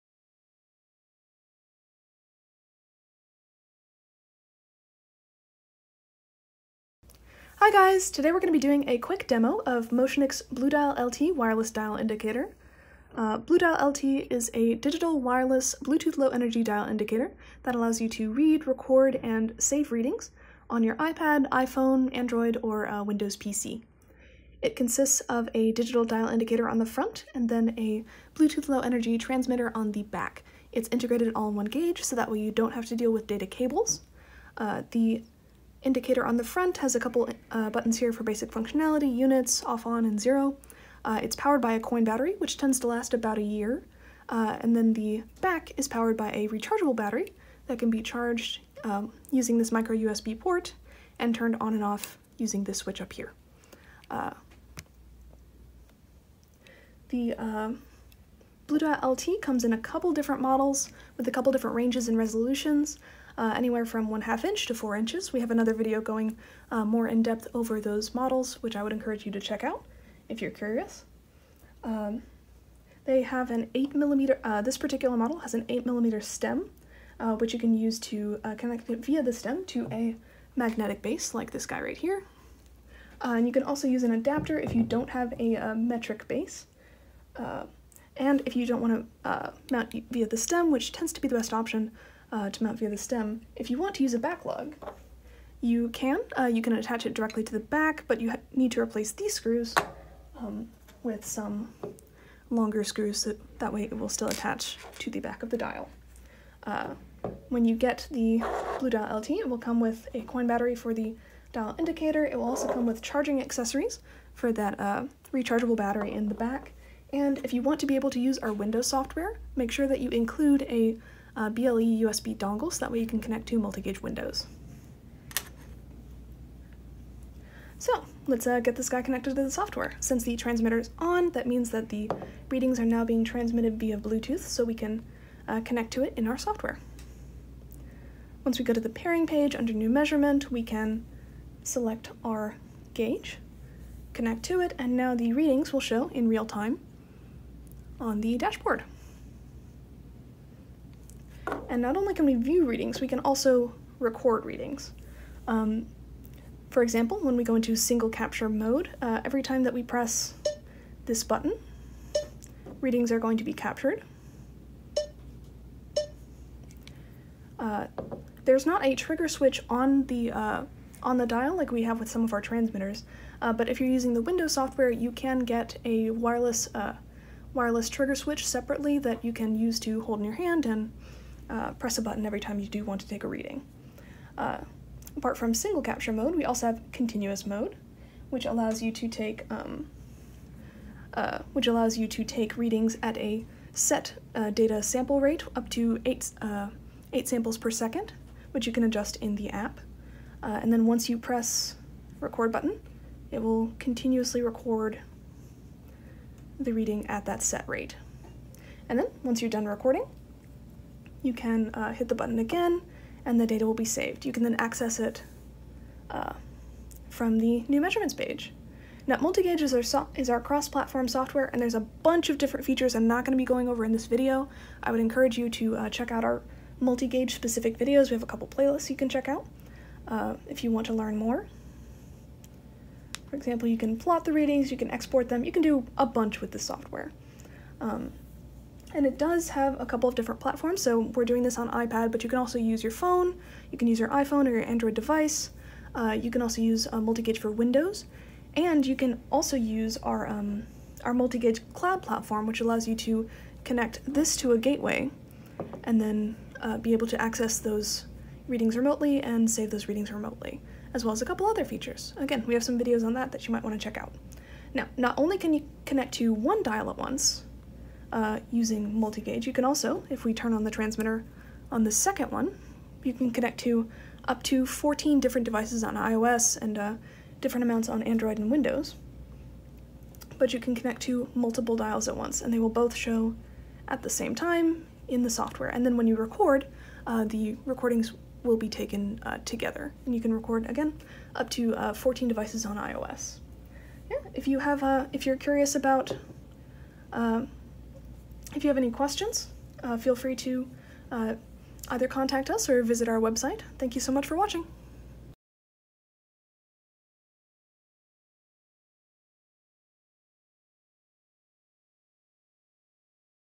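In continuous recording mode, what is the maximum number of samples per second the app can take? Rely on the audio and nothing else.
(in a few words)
8.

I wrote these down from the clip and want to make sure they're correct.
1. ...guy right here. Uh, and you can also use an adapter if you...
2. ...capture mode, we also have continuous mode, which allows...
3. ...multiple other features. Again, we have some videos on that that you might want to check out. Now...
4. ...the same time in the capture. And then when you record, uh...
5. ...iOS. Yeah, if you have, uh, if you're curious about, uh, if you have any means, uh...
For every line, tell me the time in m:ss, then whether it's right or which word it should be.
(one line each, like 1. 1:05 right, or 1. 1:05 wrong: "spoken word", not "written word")
1. 1:21 right
2. 3:05 right
3. 4:21 wrong: "couple", not "multiple"
4. 4:44 wrong: "software", not "capture"
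5. 4:52 wrong: "questions", not "means".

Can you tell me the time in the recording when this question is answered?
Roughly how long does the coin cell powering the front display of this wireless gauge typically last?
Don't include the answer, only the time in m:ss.
0:43.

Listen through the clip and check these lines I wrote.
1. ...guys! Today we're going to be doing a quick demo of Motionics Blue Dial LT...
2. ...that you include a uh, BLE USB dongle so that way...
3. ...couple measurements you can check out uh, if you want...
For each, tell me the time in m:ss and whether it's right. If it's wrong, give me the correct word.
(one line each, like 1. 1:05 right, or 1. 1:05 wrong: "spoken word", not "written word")
1. 0:07 right
2. 1:59 right
3. 3:48 wrong: "playlists", not "measurements".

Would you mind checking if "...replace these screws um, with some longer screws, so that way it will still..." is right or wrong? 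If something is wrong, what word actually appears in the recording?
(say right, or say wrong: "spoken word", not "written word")
right.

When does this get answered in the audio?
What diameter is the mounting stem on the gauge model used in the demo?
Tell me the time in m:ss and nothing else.
1:15.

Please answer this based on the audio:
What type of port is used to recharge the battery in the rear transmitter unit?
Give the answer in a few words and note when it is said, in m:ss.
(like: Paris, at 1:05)
micro USB, at 0:49.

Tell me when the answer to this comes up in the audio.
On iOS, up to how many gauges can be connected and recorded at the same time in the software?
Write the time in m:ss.
4:34.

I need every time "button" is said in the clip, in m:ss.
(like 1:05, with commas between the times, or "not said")
0:37, 2:41, 3:02, 3:22, 3:32.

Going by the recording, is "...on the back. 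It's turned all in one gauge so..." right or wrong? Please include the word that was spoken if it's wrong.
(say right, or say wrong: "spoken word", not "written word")
wrong: "integrated", not "turned".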